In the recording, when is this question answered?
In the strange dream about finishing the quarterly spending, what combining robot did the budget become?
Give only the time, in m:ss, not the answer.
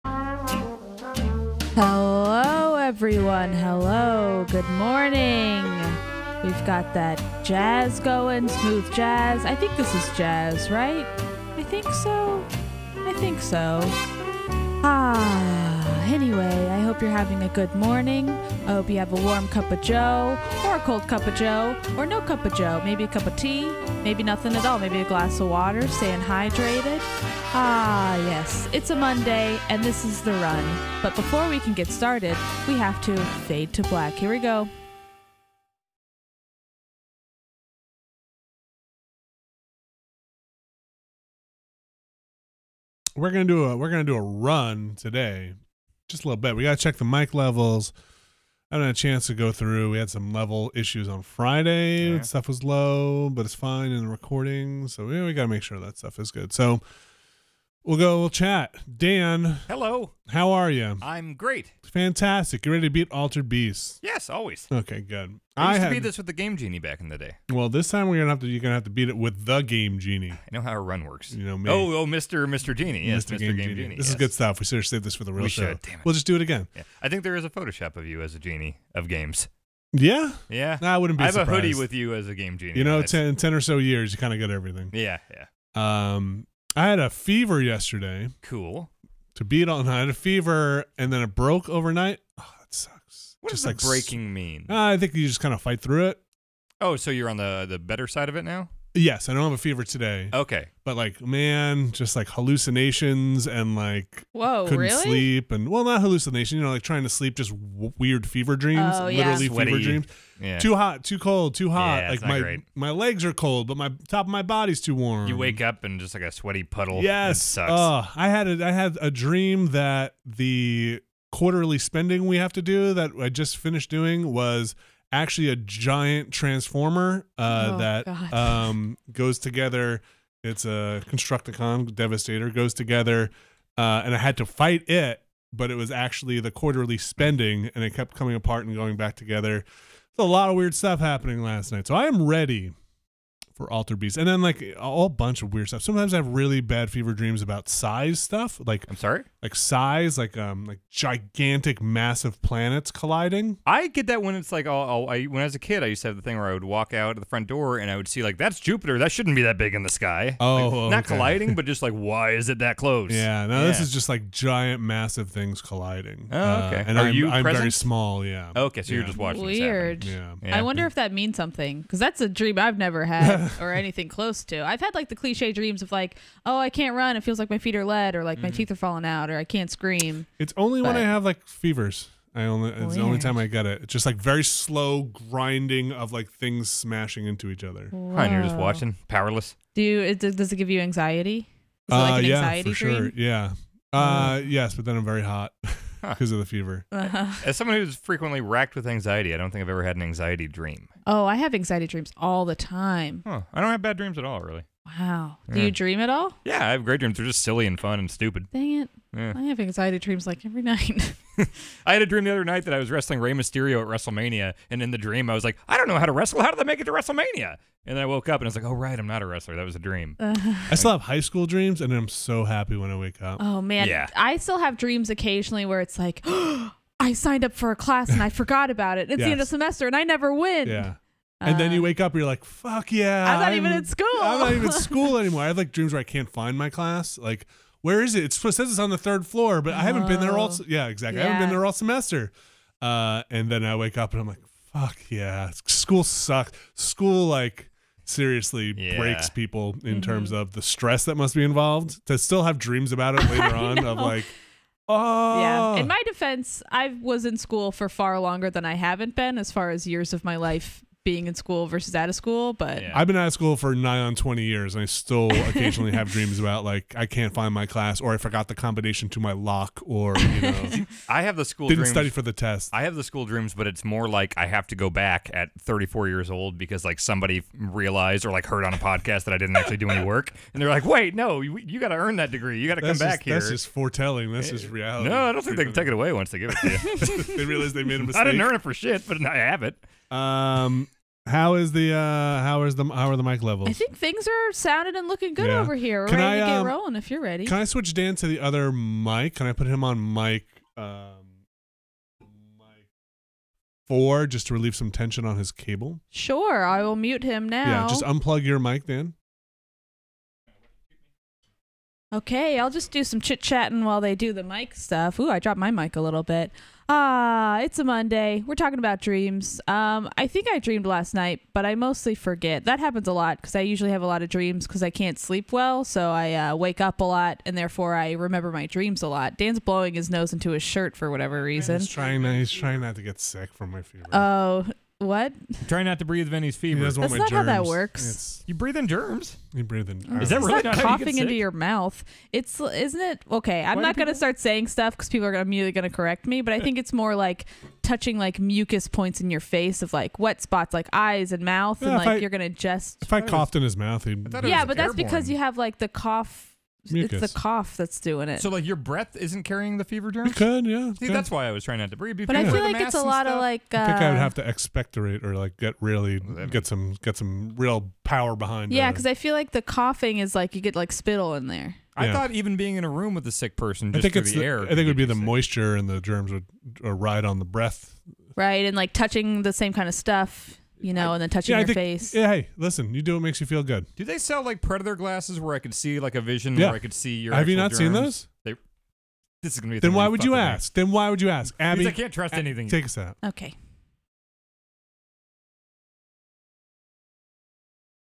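2:11.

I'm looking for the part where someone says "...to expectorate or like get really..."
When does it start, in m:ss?
6:04.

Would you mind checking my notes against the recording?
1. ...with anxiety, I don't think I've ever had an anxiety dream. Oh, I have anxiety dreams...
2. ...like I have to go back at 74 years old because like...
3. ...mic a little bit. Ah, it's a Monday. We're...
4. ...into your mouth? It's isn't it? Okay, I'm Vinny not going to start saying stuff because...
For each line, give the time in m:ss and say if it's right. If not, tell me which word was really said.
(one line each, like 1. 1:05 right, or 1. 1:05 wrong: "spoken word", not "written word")
1. 3:18 right
2. 4:34 wrong: "34", not "74"
3. 5:15 right
4. 5:41 wrong: "Why", not "Vinny".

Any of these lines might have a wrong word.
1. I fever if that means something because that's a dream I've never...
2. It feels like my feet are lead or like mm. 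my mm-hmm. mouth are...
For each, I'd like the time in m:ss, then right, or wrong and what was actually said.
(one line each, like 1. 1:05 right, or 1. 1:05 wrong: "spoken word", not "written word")
1. 2:50 wrong: "wonder", not "fever"
2. 2:57 wrong: "teeth", not "mouth".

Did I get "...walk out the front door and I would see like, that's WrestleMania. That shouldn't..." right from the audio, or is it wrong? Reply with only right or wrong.
wrong.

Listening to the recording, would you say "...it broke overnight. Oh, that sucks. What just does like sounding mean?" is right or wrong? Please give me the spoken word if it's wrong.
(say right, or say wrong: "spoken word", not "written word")
wrong: "breaking", not "sounding".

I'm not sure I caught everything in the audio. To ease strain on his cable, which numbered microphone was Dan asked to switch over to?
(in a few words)
4.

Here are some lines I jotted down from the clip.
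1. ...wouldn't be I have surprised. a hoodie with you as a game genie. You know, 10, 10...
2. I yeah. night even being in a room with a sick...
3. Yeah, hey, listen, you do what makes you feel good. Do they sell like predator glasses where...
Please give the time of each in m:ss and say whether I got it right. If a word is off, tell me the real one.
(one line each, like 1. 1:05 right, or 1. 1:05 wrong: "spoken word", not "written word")
1. 1:20 right
2. 6:11 wrong: "thought", not "night"
3. 6:22 right.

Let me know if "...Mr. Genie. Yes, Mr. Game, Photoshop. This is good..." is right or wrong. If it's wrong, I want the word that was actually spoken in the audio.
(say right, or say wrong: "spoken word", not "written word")
wrong: "Genie", not "Photoshop".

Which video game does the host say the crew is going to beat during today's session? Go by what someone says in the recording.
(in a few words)
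Altered Beast.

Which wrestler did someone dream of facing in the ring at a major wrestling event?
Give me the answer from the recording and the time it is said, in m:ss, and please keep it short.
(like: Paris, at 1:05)
Rey Mysterio, at 3:33.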